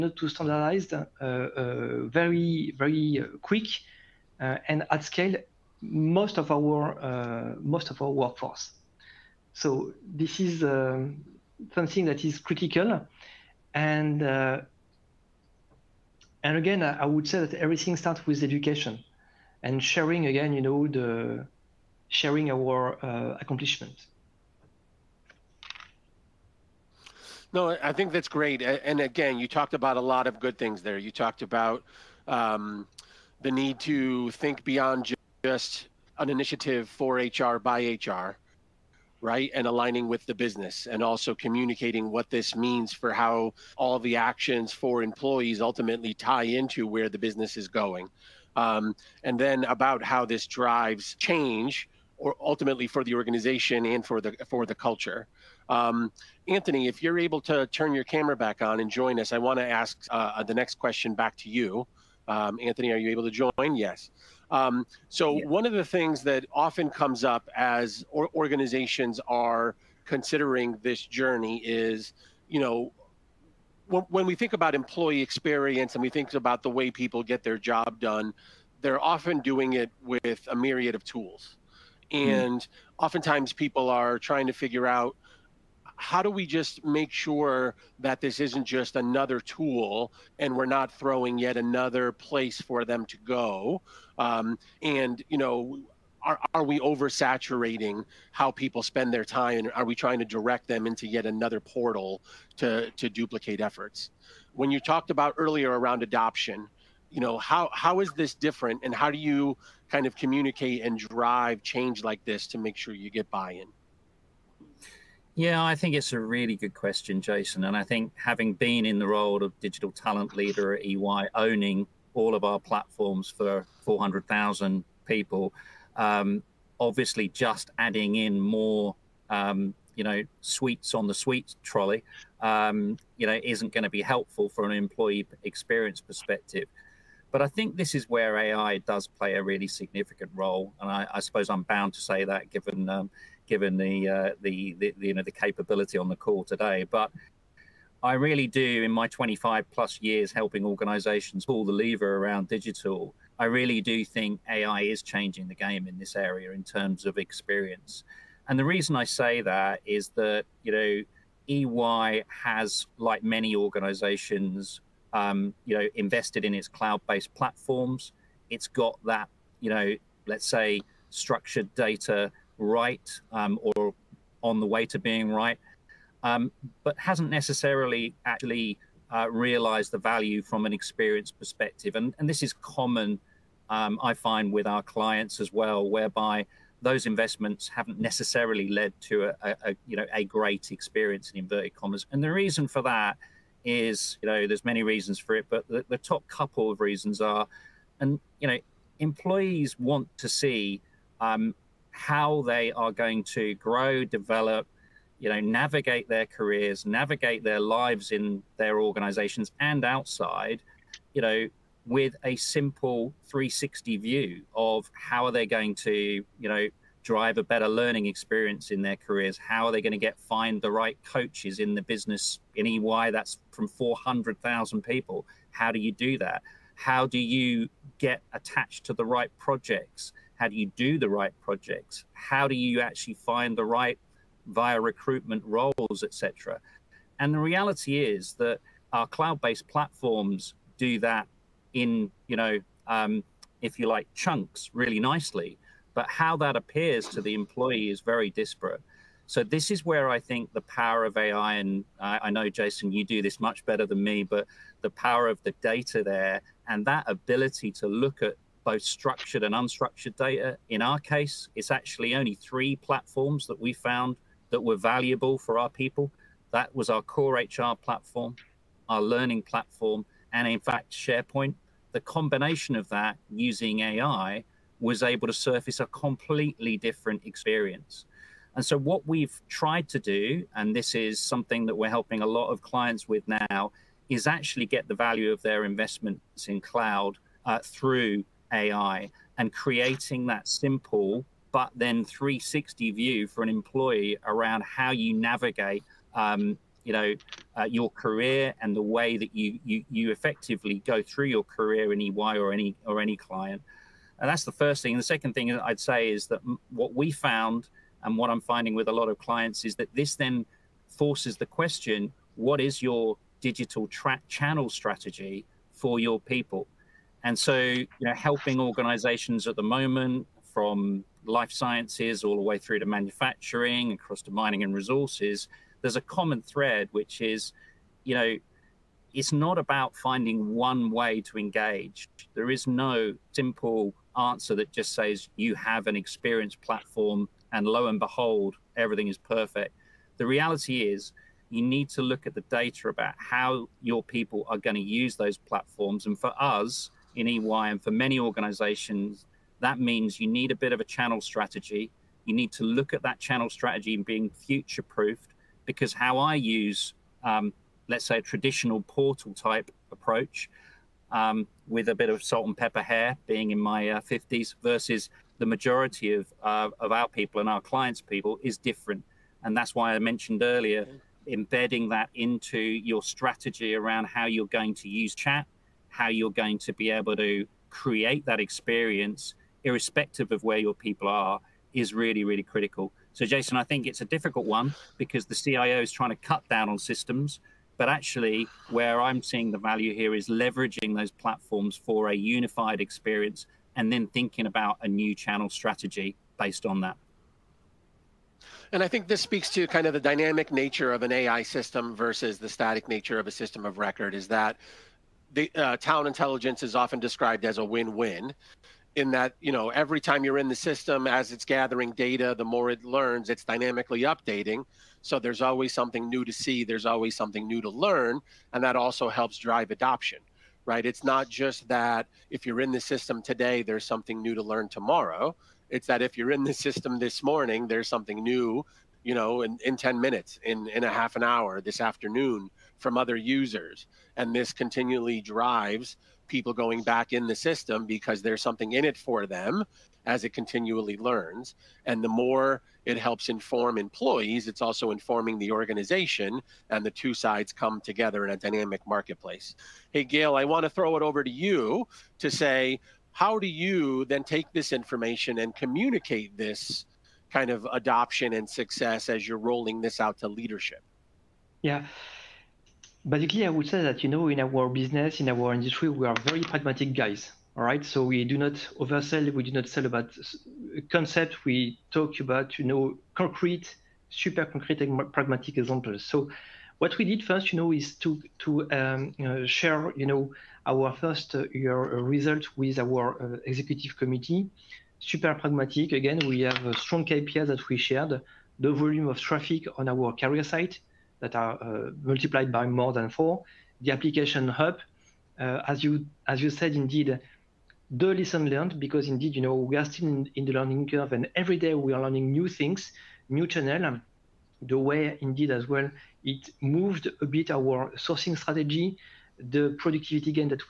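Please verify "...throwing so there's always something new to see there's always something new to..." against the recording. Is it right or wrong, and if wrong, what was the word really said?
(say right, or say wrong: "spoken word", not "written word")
wrong: "updating", not "throwing".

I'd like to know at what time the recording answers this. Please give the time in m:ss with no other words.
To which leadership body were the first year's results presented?
8:03.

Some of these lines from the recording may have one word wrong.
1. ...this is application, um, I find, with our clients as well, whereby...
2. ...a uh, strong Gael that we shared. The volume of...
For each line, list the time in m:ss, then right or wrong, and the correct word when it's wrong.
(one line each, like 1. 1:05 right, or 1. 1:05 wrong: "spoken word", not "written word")
1. 3:02 wrong: "common", not "application"
2. 8:06 wrong: "KPI", not "Gael".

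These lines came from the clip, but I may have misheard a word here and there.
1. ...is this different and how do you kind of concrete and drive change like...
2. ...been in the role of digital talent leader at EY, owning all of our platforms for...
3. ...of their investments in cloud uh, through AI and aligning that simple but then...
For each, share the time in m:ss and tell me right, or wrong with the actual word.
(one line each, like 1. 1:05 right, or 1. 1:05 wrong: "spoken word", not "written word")
1. 1:48 wrong: "communicate", not "concrete"
2. 1:58 right
3. 4:45 wrong: "creating", not "aligning".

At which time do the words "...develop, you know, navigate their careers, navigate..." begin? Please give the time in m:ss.
3:24.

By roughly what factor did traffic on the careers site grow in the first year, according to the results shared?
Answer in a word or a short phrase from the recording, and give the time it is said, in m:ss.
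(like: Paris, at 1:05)
more than 4, at 8:12.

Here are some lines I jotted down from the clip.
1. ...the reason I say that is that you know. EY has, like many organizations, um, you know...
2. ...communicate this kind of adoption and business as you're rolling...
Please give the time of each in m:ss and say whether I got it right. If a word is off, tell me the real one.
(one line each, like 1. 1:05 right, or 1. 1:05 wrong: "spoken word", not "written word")
1. 2:38 right
2. 7:35 wrong: "success", not "business".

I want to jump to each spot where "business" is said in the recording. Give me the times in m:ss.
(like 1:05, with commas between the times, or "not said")
0:40, 0:47, 3:41, 7:44.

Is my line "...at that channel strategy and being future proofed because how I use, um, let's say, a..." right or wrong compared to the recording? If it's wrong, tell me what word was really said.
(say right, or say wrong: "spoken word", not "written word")
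right.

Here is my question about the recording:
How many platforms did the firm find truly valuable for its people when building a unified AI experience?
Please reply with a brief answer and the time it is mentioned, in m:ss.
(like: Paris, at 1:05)
3, at 4:22.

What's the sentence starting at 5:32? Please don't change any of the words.
There is no simple answer that just says you have an experience platform and lo and behold, everything is perfect.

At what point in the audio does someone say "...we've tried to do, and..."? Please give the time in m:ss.
4:39.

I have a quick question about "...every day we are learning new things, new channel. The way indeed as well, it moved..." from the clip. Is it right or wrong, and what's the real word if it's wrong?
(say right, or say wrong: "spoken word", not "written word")
right.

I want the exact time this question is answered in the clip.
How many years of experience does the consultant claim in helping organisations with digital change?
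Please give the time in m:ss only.
2:29.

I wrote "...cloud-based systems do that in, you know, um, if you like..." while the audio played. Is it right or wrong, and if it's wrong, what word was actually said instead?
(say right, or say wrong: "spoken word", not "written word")
wrong: "platforms", not "systems".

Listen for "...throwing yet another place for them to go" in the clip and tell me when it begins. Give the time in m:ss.
1:30.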